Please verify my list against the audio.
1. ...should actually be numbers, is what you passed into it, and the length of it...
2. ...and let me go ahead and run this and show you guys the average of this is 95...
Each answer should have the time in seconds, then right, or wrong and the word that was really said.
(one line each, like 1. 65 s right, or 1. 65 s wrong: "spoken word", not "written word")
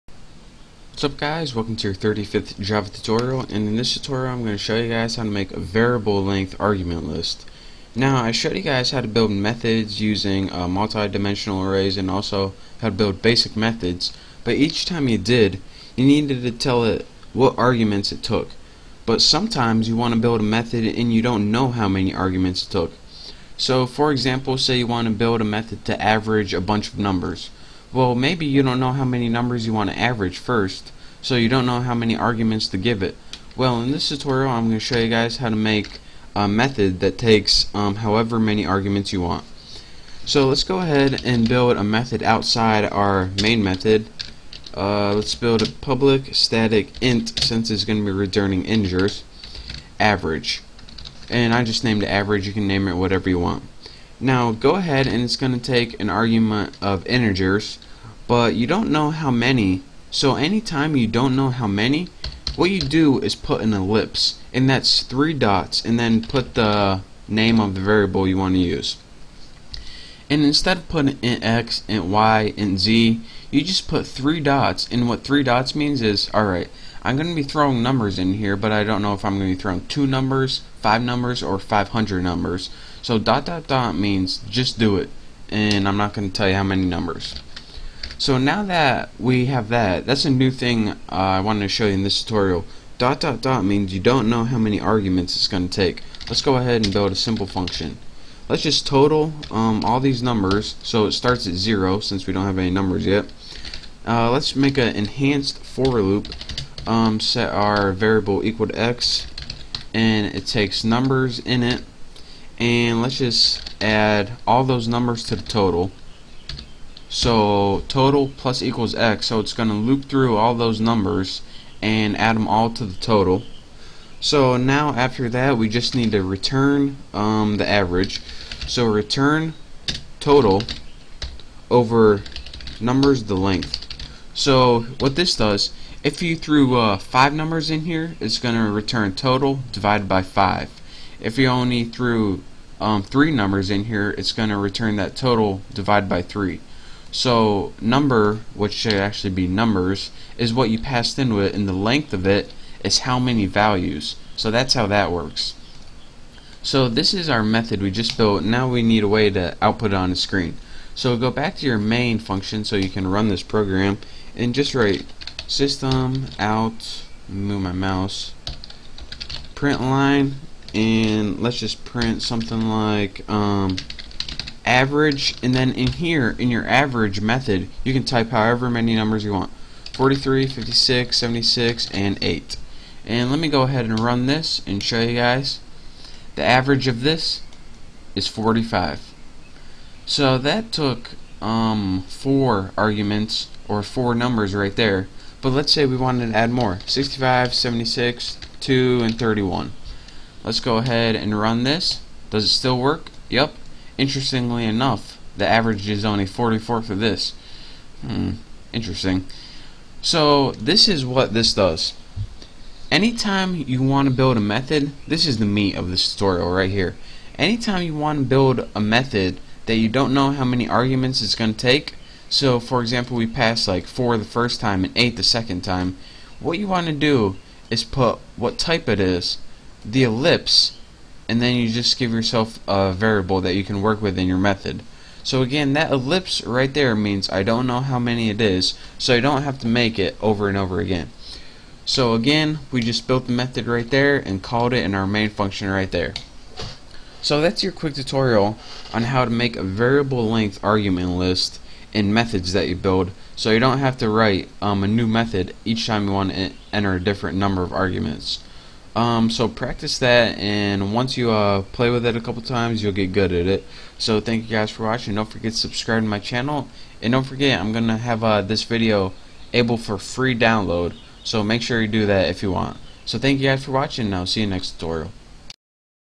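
1. 148 s right
2. 183 s wrong: "45", not "95".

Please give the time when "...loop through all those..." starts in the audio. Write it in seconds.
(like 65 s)
119 s.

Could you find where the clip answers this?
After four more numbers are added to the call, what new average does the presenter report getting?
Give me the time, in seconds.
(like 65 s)
206 s.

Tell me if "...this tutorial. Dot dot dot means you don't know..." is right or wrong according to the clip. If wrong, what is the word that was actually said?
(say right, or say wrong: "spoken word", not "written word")
right.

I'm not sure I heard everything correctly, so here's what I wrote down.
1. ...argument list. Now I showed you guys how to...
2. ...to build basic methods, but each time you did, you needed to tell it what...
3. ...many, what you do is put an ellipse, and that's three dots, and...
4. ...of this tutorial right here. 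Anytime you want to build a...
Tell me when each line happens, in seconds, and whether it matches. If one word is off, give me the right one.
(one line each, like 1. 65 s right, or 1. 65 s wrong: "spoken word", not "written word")
1. 6 s right
2. 12 s right
3. 61 s right
4. 215 s right.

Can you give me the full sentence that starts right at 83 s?
So dot dot dot means just do it, and I'm not going to tell you how many numbers.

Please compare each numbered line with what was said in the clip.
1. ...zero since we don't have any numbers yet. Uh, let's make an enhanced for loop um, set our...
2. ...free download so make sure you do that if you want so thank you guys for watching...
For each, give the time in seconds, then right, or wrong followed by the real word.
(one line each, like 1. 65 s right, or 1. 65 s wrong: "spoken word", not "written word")
1. 101 s right
2. 269 s right.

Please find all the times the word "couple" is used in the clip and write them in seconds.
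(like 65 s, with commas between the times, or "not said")
262 s.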